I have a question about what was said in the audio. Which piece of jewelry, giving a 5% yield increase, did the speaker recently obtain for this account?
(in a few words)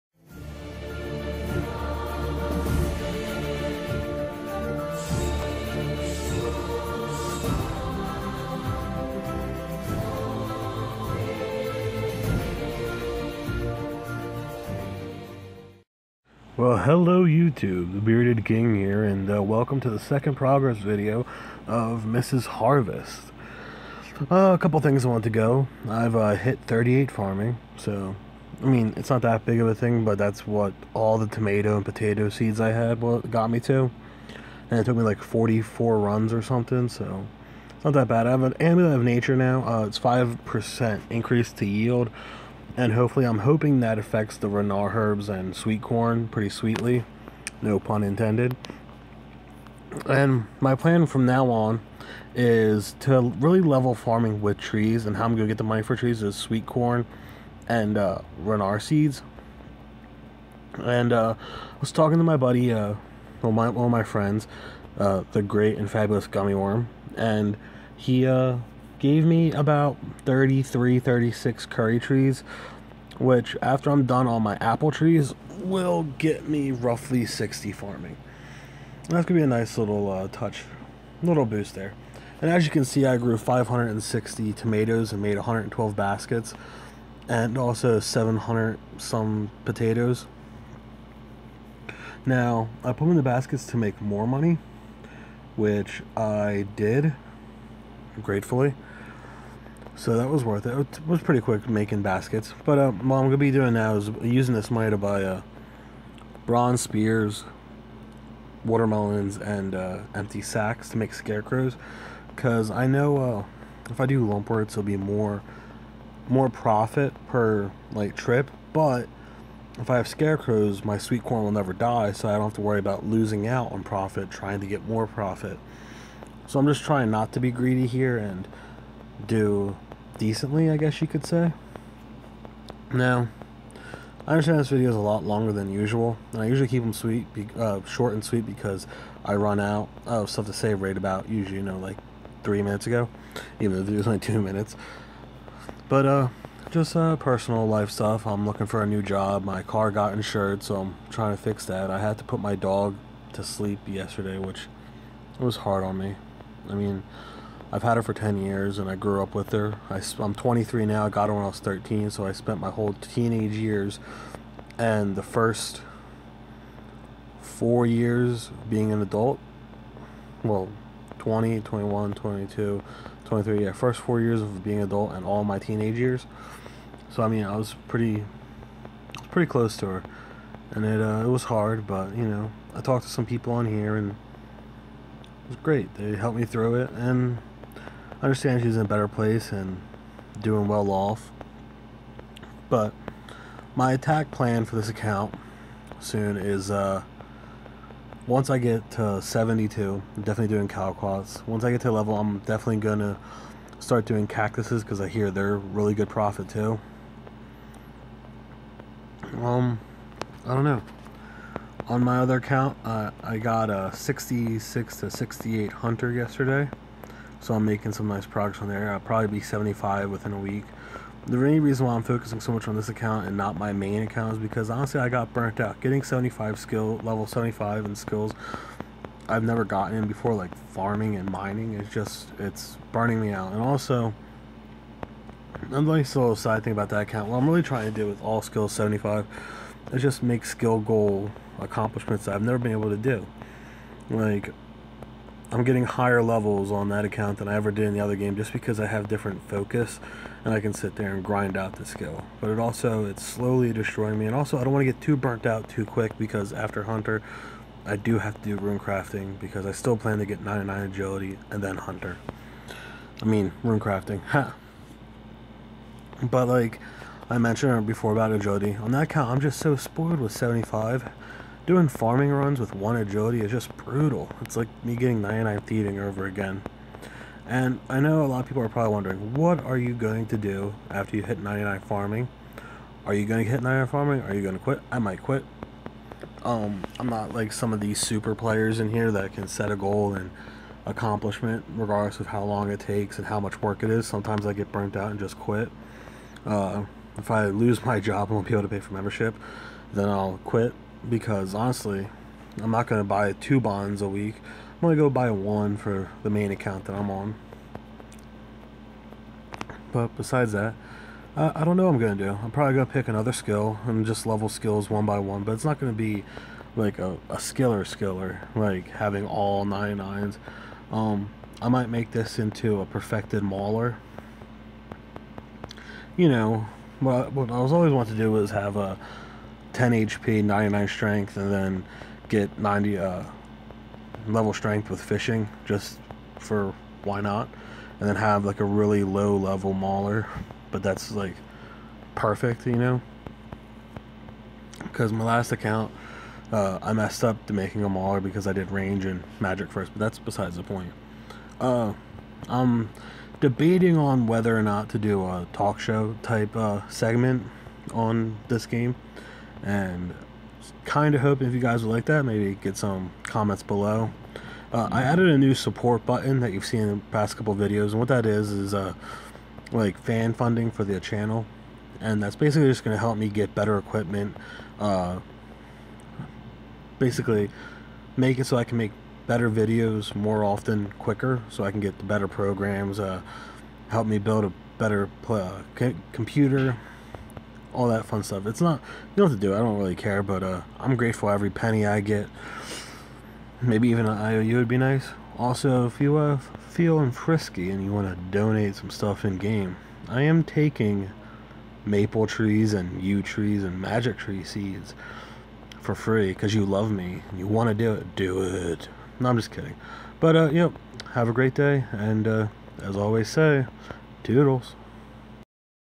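Amulet of nature.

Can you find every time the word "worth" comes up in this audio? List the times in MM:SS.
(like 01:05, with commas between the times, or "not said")
01:40.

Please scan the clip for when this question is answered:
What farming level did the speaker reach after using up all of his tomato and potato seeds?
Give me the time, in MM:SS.
00:26.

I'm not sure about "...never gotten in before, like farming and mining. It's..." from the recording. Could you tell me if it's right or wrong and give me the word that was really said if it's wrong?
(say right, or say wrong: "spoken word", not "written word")
right.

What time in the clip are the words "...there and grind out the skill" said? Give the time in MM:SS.
04:10.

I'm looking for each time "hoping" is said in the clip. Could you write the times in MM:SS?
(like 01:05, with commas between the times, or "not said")
00:43, 06:01.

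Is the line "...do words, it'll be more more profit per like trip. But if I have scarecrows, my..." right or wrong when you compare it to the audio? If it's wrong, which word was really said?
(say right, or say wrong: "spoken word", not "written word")
right.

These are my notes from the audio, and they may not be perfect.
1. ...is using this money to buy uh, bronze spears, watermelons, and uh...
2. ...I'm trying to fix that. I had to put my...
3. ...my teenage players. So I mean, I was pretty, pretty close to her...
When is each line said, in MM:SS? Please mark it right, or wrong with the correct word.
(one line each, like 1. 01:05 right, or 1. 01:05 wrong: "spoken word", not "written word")
1. 01:43 right
2. 02:30 right
3. 02:55 wrong: "years", not "players".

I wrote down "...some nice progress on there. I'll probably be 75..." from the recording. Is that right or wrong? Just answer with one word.
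right.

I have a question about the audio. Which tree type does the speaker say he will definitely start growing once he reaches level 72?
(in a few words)
Calquats.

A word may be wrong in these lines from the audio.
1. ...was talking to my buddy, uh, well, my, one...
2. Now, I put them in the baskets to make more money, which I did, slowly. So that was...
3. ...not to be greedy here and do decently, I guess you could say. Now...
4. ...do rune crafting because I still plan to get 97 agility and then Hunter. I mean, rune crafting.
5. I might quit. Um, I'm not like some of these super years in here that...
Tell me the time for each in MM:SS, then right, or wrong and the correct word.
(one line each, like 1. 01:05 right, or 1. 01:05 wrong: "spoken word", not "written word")
1. 01:01 right
2. 01:32 wrong: "gratefully", not "slowly"
3. 02:07 right
4. 04:18 wrong: "99", not "97"
5. 04:44 wrong: "players", not "years".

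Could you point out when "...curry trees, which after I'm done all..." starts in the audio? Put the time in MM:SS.
01:11.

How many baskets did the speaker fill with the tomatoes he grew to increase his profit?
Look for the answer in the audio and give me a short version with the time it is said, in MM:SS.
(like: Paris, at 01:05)
112, at 01:25.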